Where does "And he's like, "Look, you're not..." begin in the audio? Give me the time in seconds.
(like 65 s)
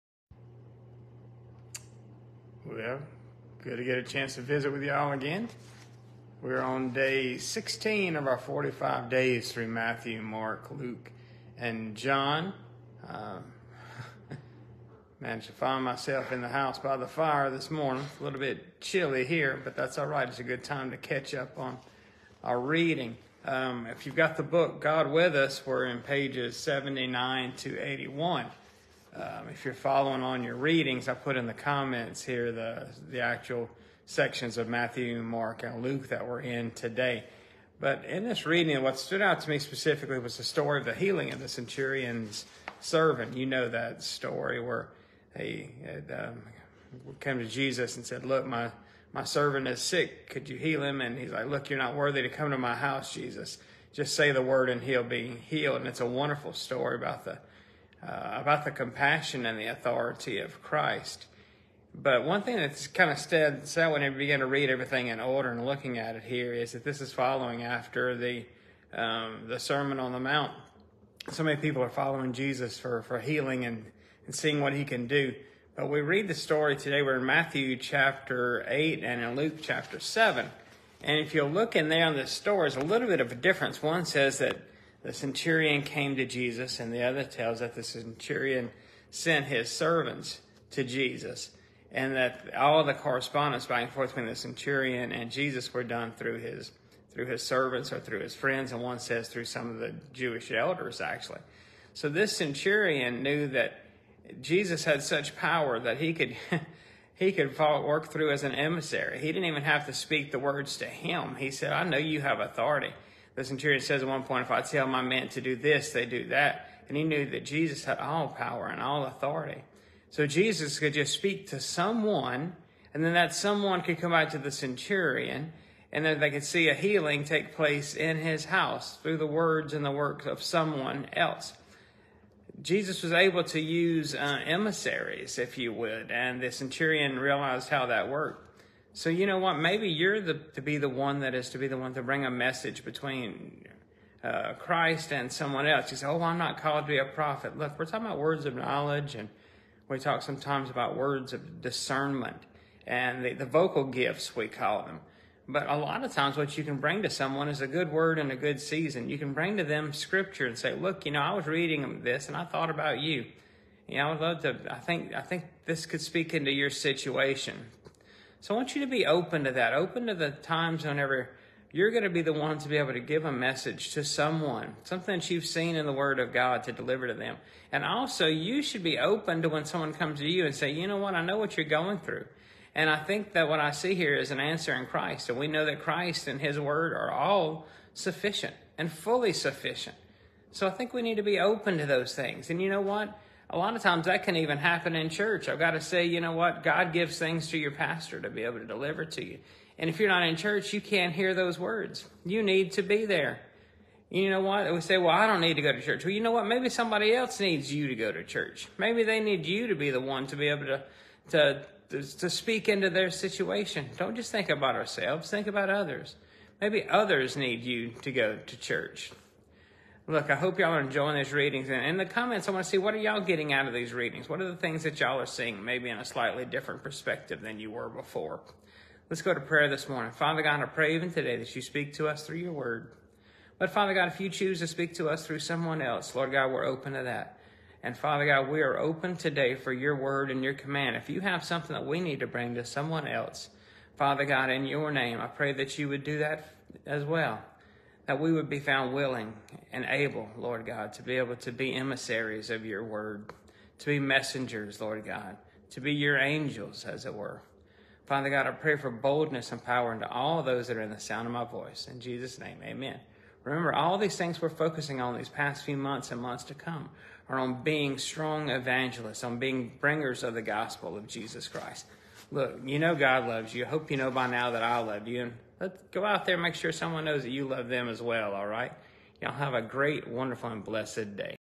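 51 s.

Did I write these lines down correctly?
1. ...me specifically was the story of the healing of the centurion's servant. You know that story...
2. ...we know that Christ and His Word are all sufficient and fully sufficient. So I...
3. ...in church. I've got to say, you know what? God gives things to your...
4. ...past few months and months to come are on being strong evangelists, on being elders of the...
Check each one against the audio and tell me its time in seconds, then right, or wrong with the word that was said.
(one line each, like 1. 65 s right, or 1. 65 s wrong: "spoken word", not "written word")
1. 39 s right
2. 185 s right
3. 194 s right
4. 265 s wrong: "bringers", not "elders".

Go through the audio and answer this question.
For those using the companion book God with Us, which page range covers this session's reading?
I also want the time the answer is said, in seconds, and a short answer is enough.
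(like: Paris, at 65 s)
79 to 81, at 26 s.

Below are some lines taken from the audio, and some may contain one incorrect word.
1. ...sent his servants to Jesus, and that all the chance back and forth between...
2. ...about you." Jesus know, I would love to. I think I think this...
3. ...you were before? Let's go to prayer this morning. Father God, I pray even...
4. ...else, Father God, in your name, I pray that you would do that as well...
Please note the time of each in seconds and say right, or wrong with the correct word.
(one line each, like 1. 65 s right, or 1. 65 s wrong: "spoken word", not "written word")
1. 89 s wrong: "correspondence", not "chance"
2. 162 s wrong: "You", not "Jesus"
3. 227 s right
4. 243 s right.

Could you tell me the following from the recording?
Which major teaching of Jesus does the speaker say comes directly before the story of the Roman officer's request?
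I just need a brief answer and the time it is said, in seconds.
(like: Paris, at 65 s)
The Sermon on the Mount, at 69 s.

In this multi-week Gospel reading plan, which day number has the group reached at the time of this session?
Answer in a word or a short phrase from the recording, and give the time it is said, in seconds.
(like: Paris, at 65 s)
16, at 6 s.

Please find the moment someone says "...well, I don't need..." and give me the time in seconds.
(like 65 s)
204 s.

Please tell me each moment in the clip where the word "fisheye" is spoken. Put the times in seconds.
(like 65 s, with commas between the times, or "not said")
not said.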